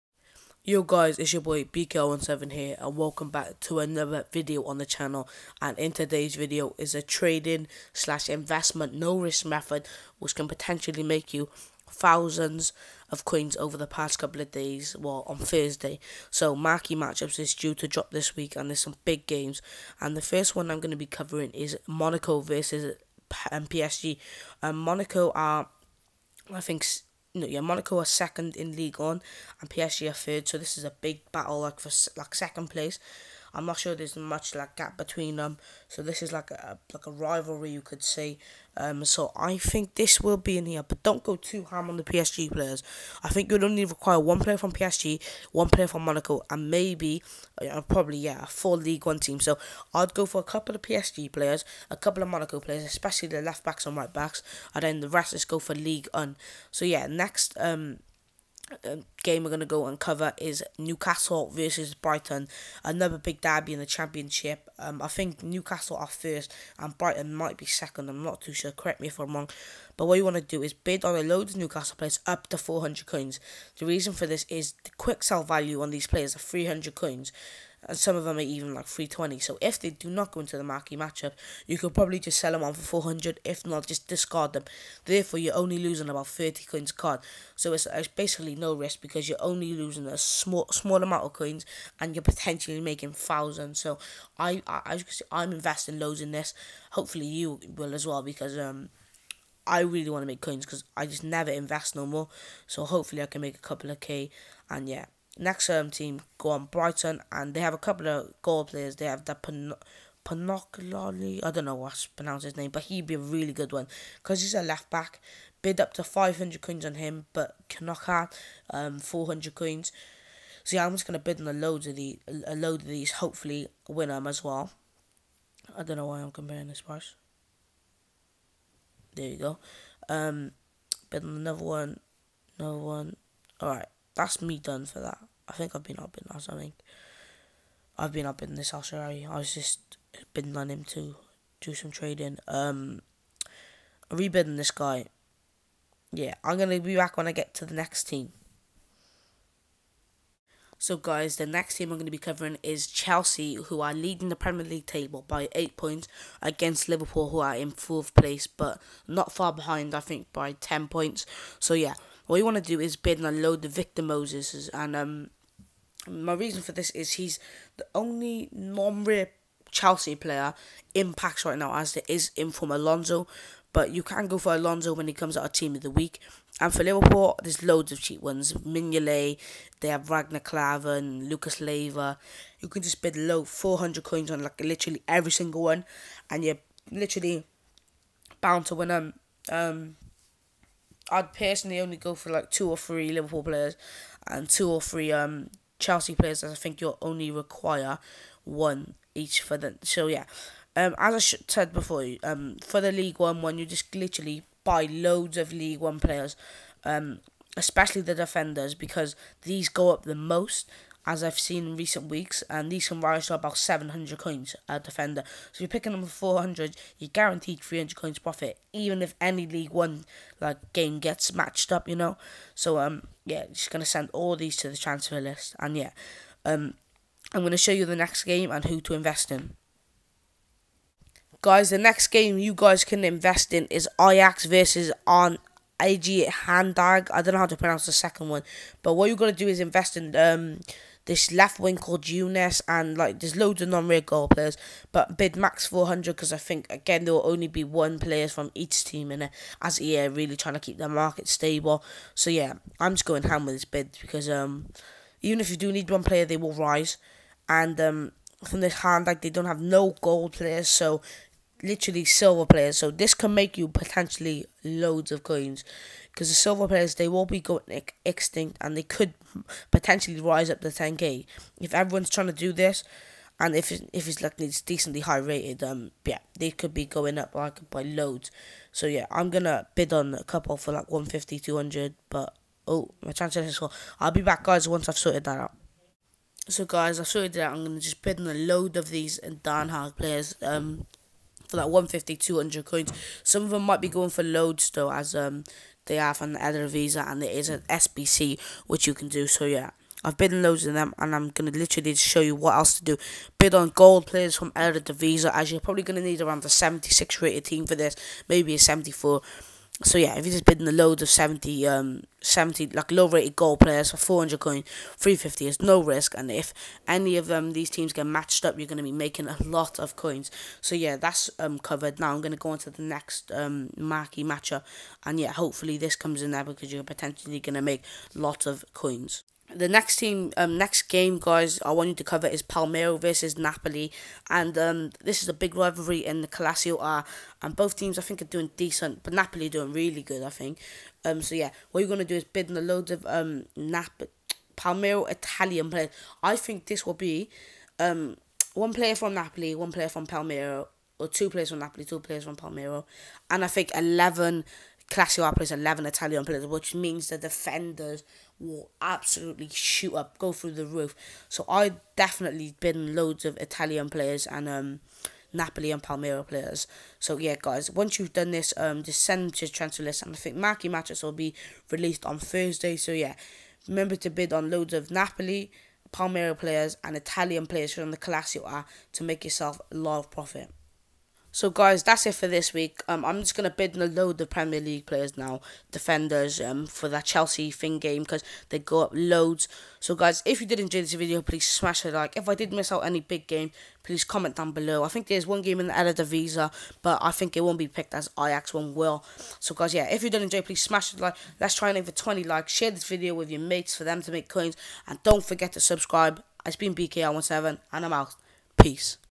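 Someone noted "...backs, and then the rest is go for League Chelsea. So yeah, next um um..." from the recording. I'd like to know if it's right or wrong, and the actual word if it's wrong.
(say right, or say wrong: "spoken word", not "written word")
wrong: "One", not "Chelsea".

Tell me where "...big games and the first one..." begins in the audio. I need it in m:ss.
0:19.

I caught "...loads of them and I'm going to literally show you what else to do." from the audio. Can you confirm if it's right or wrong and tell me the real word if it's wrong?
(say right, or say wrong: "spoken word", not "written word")
right.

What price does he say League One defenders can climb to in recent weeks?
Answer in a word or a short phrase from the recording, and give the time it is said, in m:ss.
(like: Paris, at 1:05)
700 coins, at 3:33.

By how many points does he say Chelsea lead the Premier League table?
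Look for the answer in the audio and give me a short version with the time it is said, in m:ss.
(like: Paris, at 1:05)
8 points, at 2:35.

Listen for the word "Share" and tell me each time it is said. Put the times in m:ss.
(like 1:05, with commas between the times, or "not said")
6:42.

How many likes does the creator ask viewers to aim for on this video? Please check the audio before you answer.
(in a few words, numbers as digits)
20.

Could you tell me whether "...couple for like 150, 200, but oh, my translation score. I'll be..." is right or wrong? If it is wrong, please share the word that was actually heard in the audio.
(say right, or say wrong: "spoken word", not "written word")
right.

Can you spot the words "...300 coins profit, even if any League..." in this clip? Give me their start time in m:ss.
3:37.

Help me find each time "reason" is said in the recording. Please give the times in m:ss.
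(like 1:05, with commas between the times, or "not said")
1:13, 2:46.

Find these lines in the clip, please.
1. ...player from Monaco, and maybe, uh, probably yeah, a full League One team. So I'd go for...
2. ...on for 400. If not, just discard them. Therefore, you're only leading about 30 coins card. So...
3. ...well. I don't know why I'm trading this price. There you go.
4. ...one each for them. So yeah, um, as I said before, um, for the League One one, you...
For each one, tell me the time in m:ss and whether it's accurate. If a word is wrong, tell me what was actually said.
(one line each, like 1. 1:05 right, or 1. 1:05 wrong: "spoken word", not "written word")
1. 0:45 right
2. 1:22 wrong: "losing", not "leading"
3. 2:04 wrong: "comparing", not "trading"
4. 3:18 right.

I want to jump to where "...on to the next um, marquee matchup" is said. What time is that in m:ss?
5:22.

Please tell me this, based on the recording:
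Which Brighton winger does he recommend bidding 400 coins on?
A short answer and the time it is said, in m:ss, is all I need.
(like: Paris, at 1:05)
Knockaert, at 1:57.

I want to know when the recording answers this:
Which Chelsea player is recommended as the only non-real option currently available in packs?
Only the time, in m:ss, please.
2:43.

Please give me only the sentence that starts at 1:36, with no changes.
Hopefully you will as well because um I really want to make coins because I just never invest no more.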